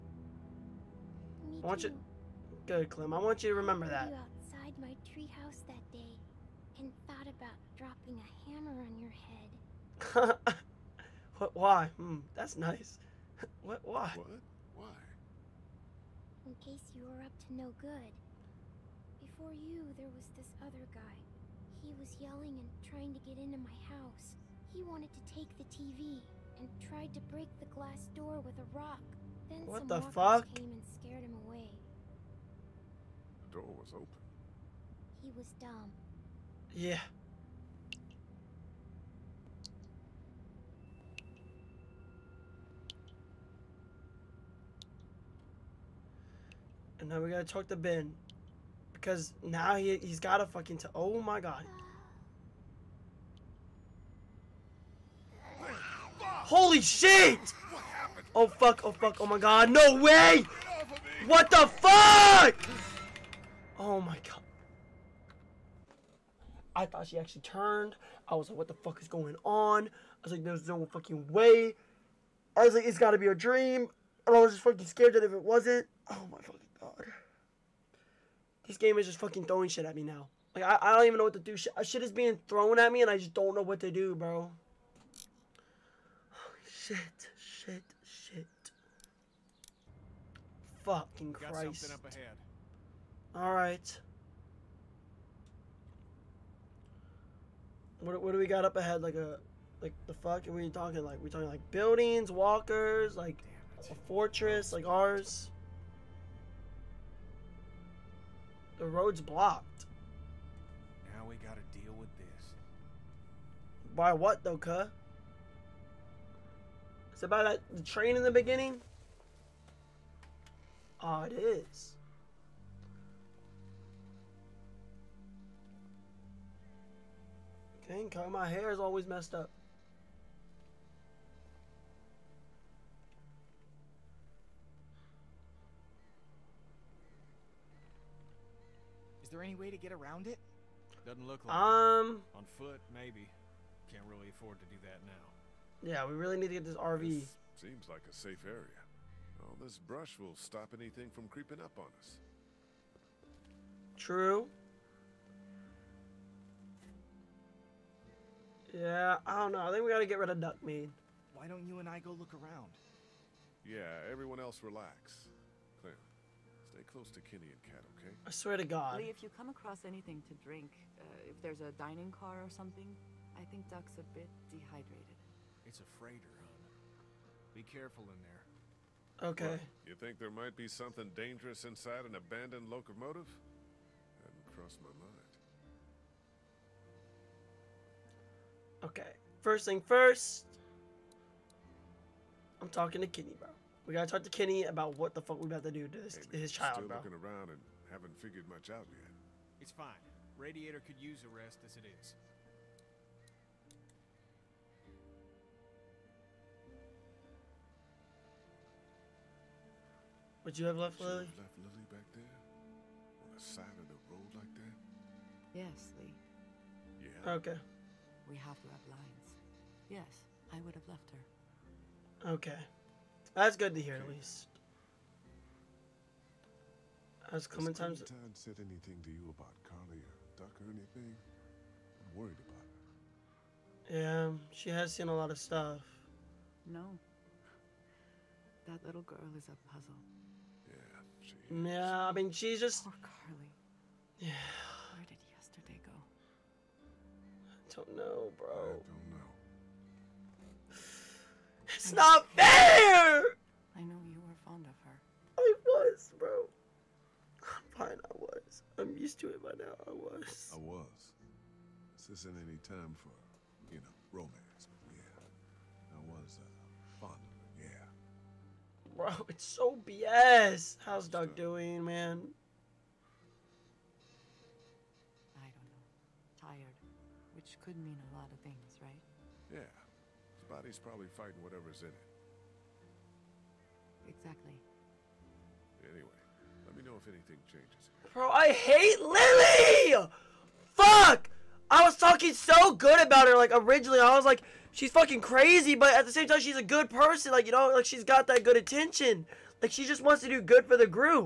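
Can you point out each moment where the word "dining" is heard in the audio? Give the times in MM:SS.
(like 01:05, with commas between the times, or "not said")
02:51.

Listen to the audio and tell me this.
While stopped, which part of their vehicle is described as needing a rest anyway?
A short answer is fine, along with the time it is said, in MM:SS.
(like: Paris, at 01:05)
Radiator, at 03:20.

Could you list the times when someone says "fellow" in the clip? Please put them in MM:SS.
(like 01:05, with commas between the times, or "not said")
not said.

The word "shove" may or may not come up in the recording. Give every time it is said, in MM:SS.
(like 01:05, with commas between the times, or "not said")
not said.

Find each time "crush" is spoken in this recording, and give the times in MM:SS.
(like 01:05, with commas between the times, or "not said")
not said.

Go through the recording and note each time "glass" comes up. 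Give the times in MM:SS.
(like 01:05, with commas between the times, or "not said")
00:27.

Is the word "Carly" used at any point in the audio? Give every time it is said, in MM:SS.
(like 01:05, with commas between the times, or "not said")
03:49, 04:03.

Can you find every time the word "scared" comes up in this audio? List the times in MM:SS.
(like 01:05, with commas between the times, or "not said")
00:30, 01:14.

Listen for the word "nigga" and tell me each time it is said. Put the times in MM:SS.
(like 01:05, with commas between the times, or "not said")
not said.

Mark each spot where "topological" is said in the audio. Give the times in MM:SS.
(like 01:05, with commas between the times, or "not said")
not said.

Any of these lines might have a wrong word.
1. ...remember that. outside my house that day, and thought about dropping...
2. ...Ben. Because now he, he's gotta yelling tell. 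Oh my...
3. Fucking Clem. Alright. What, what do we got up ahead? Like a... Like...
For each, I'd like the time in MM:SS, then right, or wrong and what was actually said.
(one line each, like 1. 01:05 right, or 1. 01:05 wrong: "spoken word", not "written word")
1. 00:03 wrong: "treehouse", not "house"
2. 00:47 wrong: "fucking", not "yelling"
3. 01:30 wrong: "Christ", not "Clem".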